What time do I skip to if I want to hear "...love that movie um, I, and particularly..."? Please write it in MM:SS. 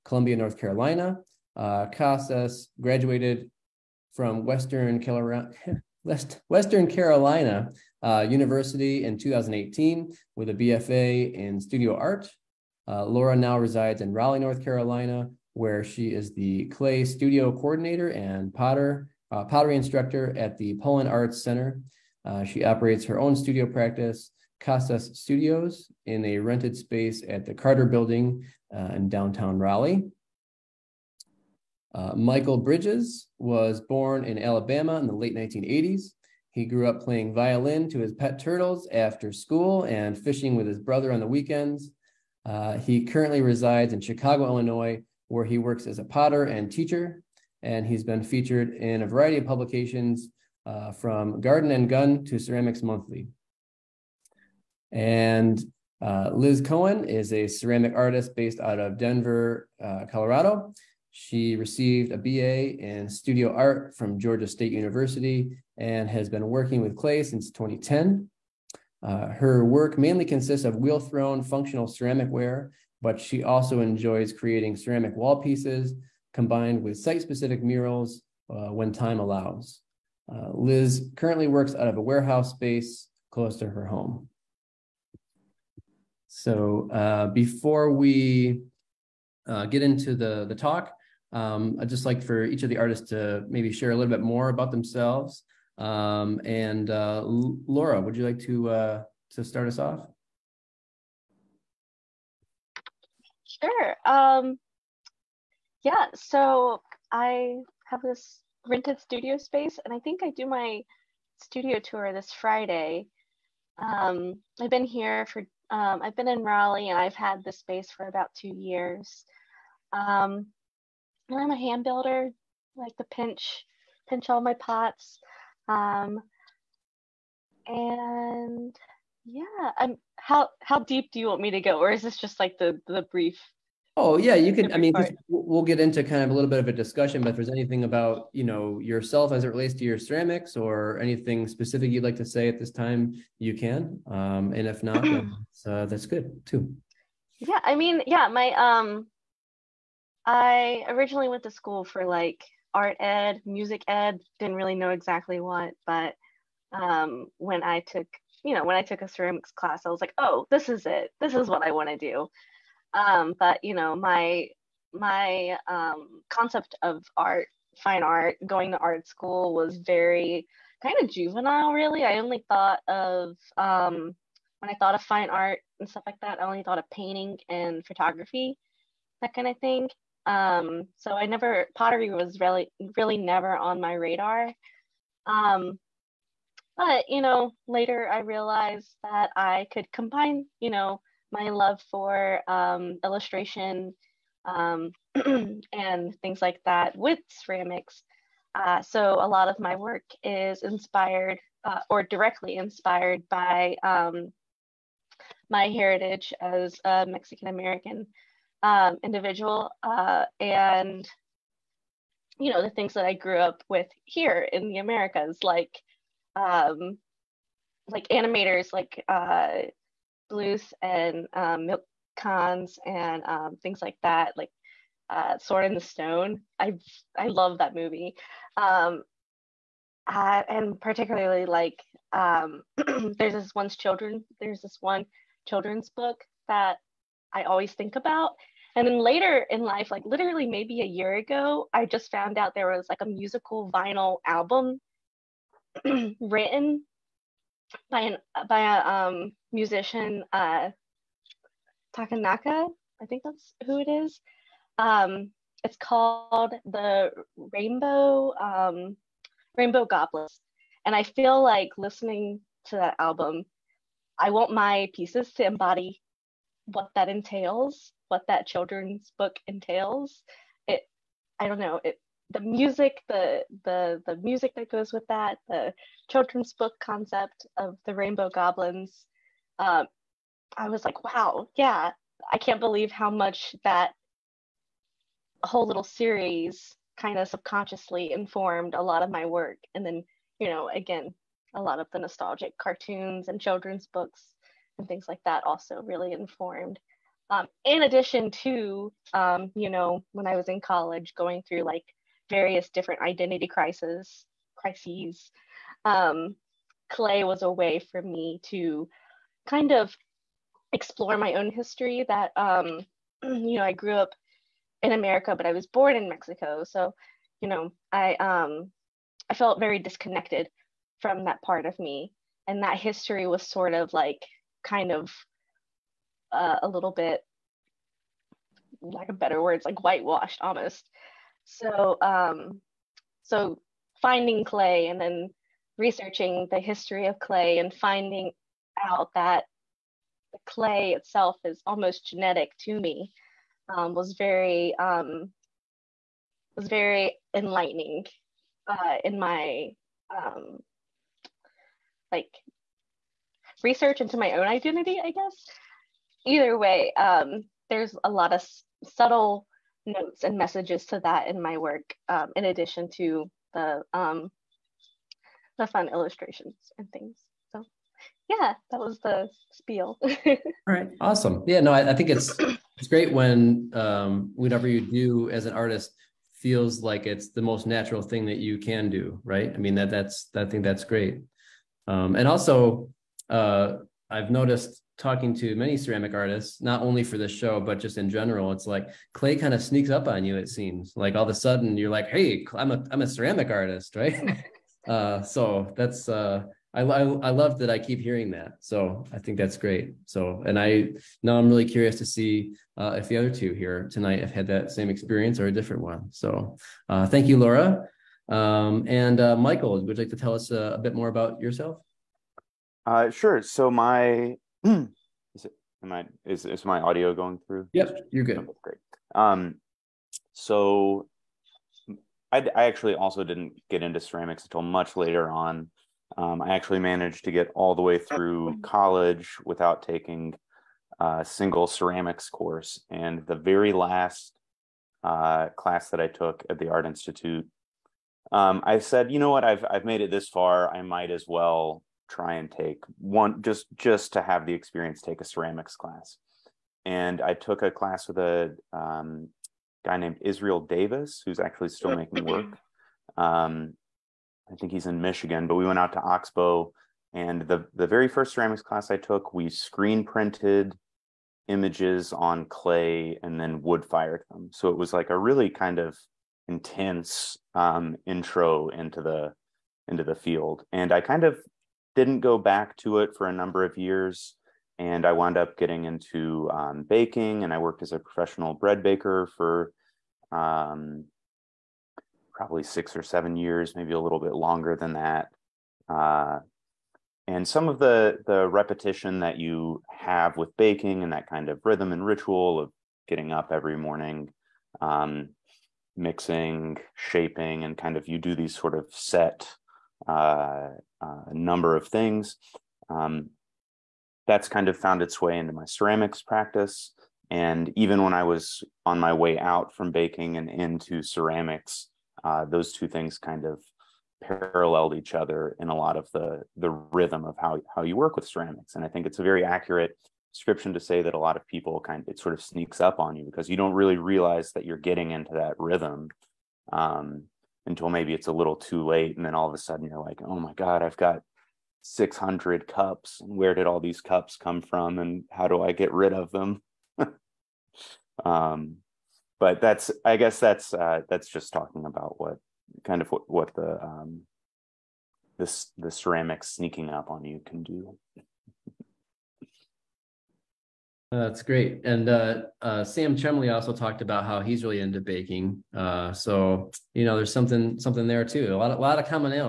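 03:47.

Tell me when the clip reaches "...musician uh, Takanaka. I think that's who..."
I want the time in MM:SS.
04:09.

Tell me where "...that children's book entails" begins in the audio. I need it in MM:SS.
04:28.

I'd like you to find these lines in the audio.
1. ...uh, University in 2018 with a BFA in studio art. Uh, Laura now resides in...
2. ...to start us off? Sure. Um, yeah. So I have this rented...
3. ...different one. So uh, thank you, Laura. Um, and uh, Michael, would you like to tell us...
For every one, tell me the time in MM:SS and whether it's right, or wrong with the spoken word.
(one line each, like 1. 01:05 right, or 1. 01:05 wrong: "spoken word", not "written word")
1. 00:08 right
2. 01:39 right
3. 06:45 right.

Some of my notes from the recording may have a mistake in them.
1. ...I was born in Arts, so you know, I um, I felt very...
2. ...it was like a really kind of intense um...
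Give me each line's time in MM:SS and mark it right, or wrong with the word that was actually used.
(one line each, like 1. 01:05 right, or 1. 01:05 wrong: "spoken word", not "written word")
1. 05:15 wrong: "Mexico", not "Arts"
2. 07:44 right.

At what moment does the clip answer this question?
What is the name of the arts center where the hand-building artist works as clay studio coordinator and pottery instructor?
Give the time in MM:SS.
00:20.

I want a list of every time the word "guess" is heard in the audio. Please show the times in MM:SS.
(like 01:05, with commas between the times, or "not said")
05:55, 09:00.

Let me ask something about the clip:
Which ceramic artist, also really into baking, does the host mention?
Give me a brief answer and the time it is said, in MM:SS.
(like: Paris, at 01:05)
Sam Chemley, at 09:12.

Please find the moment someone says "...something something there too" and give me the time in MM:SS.
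09:17.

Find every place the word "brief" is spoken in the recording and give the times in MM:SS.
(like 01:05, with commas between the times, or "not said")
02:13.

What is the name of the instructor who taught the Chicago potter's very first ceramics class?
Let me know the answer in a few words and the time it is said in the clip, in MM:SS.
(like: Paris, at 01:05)
Israel Davis, at 07:30.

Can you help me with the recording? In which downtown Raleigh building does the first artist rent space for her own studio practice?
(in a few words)
Carter Building.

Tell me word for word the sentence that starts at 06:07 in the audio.
So, yeah, that was the spiel.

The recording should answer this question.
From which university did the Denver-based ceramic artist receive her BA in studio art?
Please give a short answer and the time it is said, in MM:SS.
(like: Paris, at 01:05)
Georgia State University, at 01:04.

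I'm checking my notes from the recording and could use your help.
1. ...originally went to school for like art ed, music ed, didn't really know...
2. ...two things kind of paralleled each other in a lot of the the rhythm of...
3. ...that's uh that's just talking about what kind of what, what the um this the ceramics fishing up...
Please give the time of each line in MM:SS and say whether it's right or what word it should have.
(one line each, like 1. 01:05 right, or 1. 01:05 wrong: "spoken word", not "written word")
1. 02:30 right
2. 08:32 right
3. 09:00 wrong: "sneaking", not "fishing".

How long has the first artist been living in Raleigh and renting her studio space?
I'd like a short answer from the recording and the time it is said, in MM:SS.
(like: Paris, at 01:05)
about two years, at 01:58.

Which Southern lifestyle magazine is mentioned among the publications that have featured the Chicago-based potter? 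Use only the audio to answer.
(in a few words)
Garden and Gun.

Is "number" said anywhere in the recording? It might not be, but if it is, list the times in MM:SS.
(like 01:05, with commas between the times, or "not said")
07:53, 08:21.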